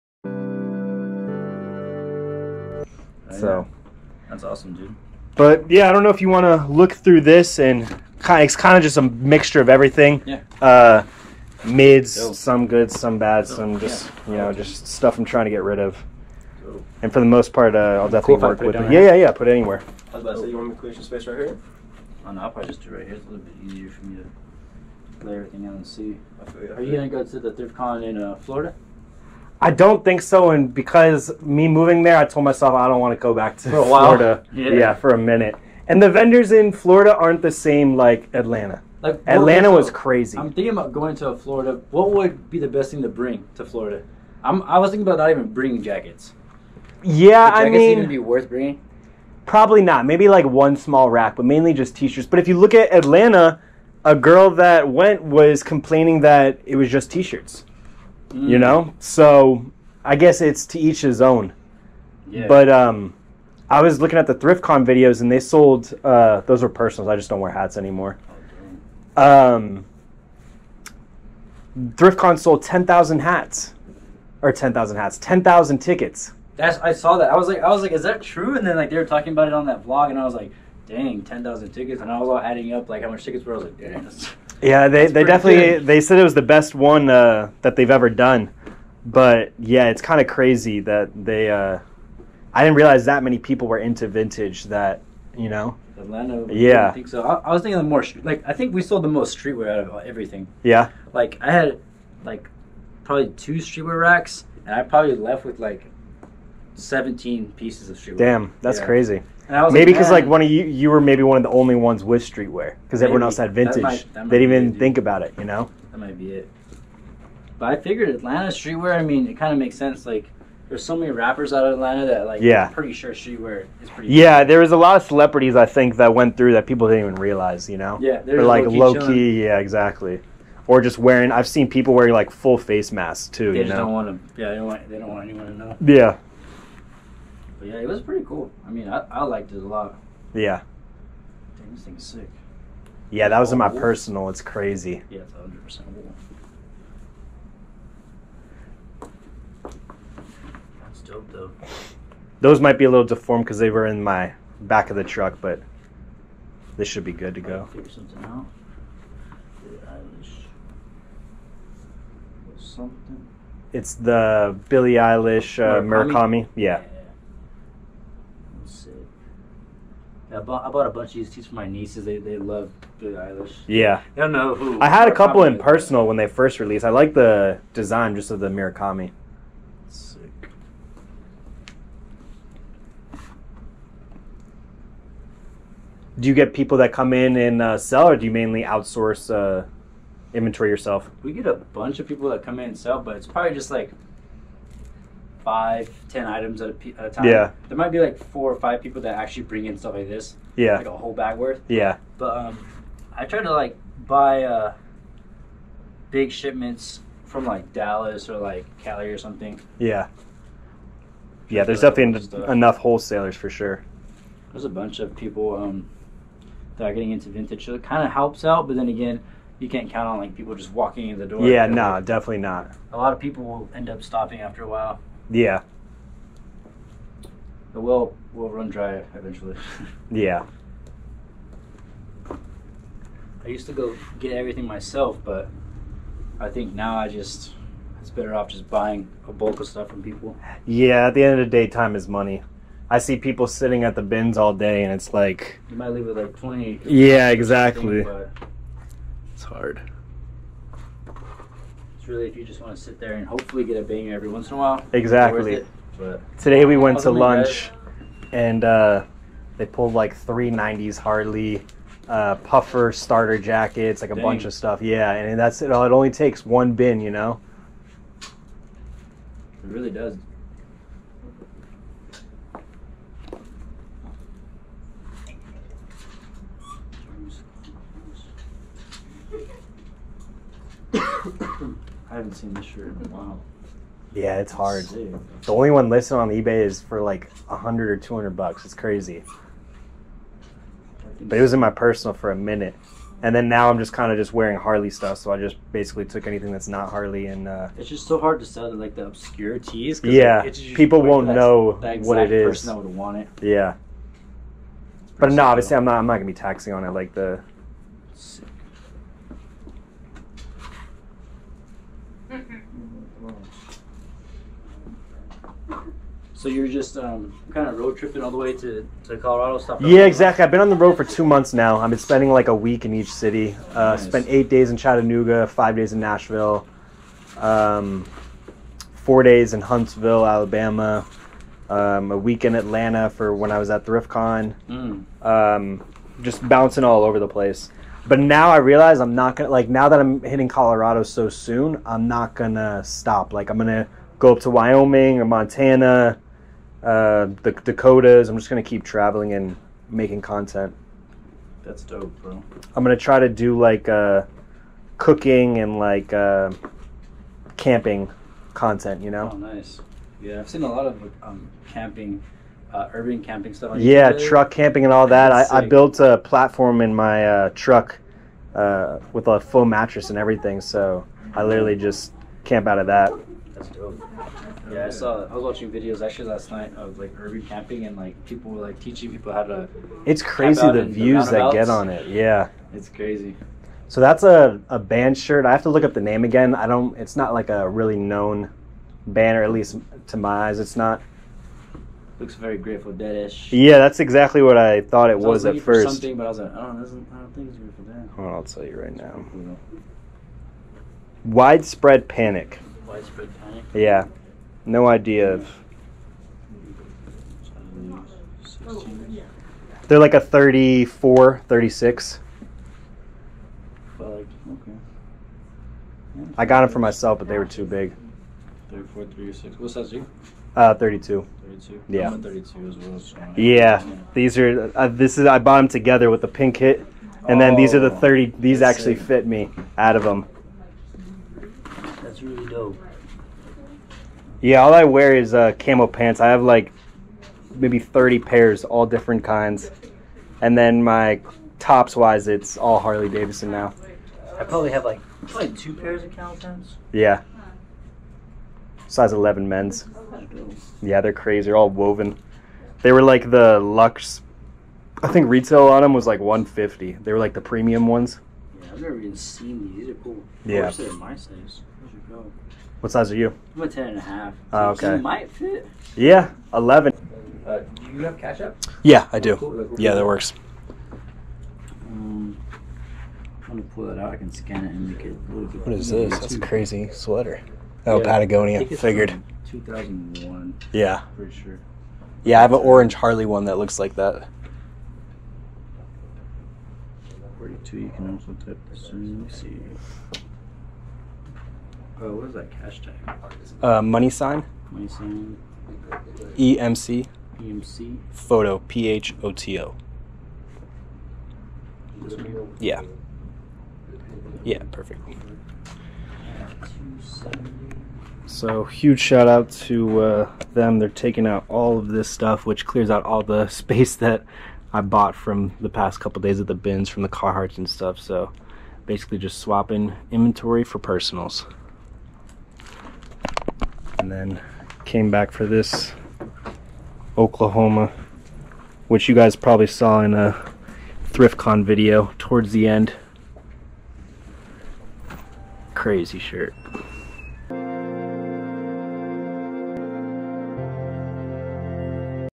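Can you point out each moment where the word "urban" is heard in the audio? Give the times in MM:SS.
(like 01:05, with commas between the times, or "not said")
06:02, 06:17.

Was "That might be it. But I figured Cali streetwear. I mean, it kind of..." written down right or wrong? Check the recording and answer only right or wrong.
wrong.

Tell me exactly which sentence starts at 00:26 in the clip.
Are you gonna go to the thrift con in uh, Florida?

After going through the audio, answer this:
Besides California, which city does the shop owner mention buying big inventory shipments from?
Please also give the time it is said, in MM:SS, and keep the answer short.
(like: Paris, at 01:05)
Dallas, at 03:27.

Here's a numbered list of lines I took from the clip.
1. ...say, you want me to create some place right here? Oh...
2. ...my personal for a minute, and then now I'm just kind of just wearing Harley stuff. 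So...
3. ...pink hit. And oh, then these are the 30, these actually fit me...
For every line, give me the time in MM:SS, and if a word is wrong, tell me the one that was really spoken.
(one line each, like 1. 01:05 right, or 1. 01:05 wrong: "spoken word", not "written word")
1. 00:20 wrong: "space", not "place"
2. 04:51 right
3. 07:06 right.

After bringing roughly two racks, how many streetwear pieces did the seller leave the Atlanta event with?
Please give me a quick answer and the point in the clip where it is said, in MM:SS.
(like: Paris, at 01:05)
17, at 01:46.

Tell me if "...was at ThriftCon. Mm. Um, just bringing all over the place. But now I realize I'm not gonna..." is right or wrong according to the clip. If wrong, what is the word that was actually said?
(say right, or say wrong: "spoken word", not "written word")
wrong: "bouncing", not "bringing".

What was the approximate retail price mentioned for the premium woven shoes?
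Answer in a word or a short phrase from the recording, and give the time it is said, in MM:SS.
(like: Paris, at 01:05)
150, at 07:36.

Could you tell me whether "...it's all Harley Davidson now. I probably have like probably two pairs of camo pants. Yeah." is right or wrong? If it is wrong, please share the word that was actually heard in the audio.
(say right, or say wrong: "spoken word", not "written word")
right.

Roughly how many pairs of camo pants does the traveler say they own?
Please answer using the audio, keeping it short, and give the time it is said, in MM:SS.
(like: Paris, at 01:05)
30, at 07:17.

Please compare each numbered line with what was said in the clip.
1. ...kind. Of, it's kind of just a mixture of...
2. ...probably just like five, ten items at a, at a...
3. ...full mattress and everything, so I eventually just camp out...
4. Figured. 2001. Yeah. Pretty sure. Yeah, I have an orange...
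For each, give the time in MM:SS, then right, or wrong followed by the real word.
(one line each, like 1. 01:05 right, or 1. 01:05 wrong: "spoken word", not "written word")
1. 00:08 right
2. 03:13 right
3. 06:09 wrong: "literally", not "eventually"
4. 07:58 right.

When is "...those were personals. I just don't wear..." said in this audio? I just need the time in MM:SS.
01:06.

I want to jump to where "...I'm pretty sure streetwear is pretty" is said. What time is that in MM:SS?
02:02.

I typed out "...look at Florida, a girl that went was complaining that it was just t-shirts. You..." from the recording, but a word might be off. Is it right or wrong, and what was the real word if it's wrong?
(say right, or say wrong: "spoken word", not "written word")
wrong: "Atlanta", not "Florida".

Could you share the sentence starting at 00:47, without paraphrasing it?
Yeah, jackets I mean, even be worth bringing.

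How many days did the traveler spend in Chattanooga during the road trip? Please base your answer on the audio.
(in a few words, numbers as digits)
8.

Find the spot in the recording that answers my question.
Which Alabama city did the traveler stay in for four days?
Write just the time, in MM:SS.
05:29.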